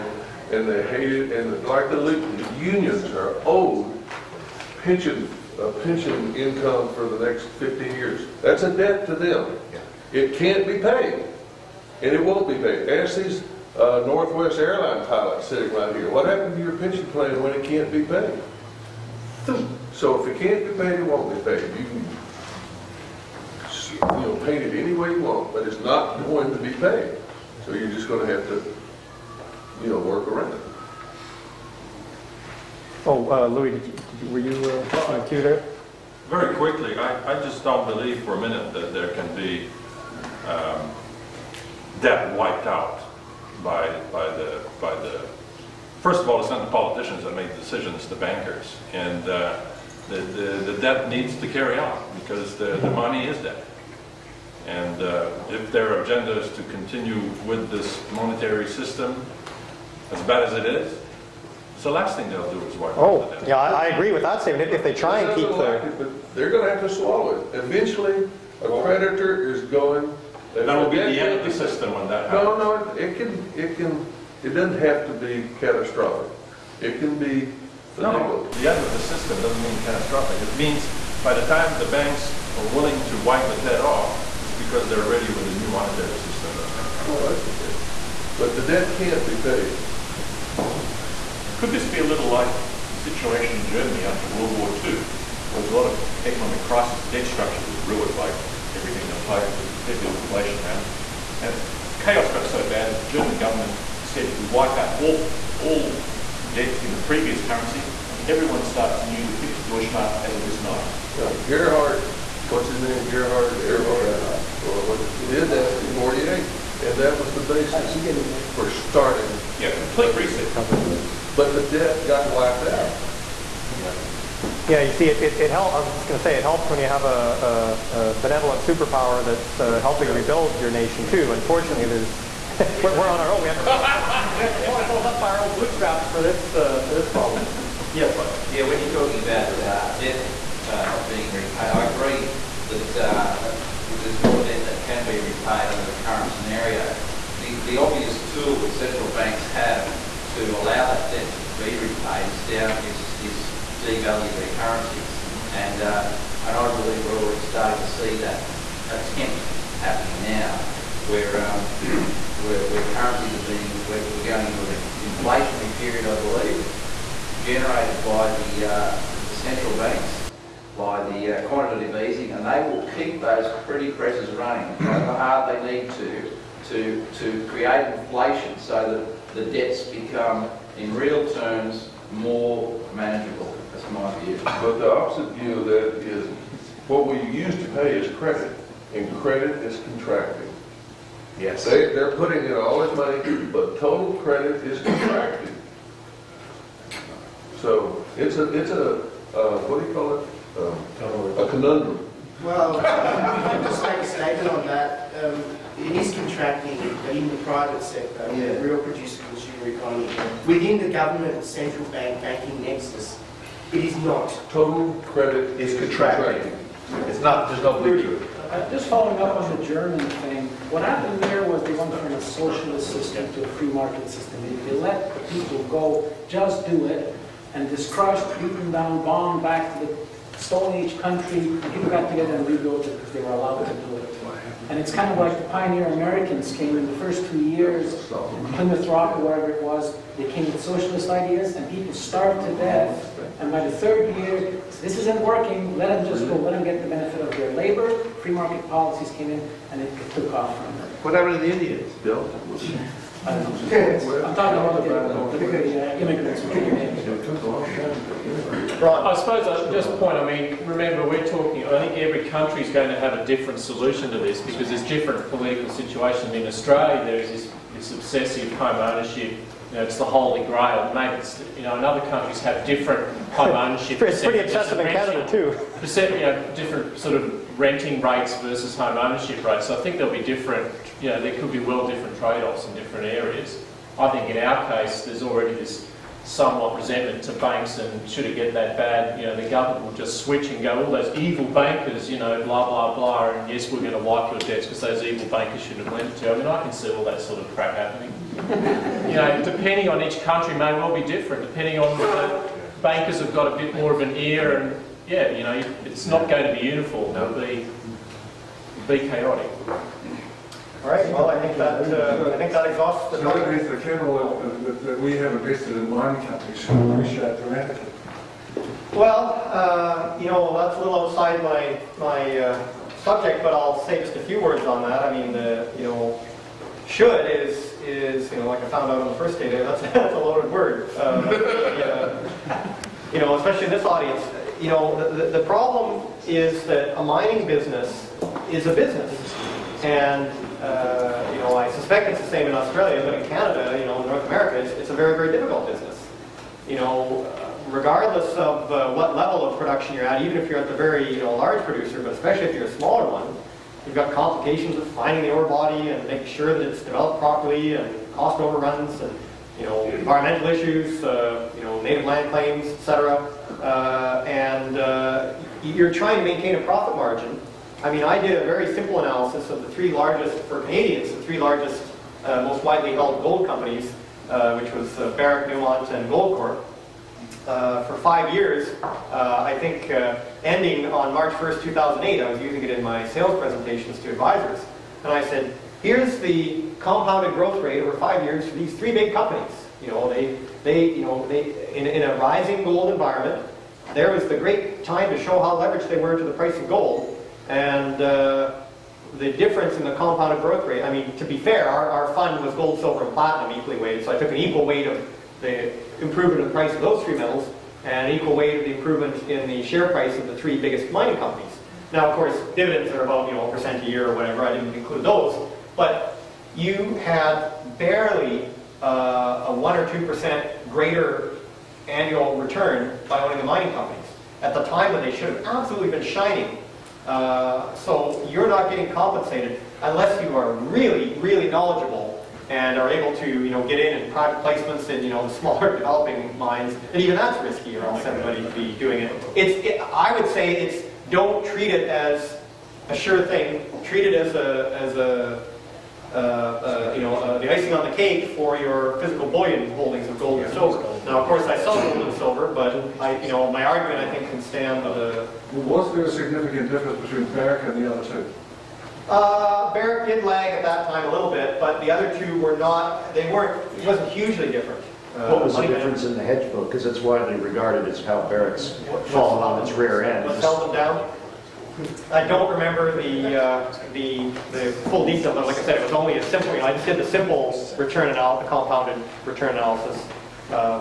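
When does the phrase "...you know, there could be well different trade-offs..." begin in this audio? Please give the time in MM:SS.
04:41.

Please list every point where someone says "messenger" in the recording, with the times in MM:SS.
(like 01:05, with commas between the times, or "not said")
not said.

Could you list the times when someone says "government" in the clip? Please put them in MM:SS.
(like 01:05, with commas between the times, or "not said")
01:43, 03:30, 04:49.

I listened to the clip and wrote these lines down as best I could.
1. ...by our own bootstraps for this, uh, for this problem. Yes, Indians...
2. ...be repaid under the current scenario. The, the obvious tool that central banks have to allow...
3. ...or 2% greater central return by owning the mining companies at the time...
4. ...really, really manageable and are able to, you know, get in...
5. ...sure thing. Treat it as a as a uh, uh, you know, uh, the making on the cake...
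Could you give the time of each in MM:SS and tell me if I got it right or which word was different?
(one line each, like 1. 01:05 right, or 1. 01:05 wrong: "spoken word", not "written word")
1. 02:15 wrong: "Yeah", not "Indians"
2. 02:25 right
3. 06:59 wrong: "annual", not "central"
4. 07:10 wrong: "knowledgeable", not "manageable"
5. 07:22 wrong: "icing", not "making".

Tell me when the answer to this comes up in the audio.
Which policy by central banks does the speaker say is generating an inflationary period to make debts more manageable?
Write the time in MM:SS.
02:51.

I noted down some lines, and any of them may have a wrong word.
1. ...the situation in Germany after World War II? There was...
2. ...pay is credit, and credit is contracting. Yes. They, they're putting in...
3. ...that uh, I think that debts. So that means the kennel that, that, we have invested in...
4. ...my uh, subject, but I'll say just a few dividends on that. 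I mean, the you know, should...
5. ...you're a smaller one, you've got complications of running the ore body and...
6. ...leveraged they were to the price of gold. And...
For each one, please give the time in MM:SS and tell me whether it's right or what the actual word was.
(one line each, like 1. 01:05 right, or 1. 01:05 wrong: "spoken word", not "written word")
1. 01:32 right
2. 03:07 right
3. 05:11 wrong: "exhausts", not "debts"
4. 05:21 wrong: "words", not "dividends"
5. 05:52 wrong: "finding", not "running"
6. 06:35 right.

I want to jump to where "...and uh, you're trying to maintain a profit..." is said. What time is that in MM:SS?
06:04.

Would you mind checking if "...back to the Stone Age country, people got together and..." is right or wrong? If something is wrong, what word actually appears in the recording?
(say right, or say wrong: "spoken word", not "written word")
right.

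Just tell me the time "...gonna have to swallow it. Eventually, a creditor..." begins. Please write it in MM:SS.
01:06.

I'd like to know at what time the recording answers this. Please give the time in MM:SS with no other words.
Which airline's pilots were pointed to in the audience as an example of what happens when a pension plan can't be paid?
00:14.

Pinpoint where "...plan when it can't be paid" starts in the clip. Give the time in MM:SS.
00:17.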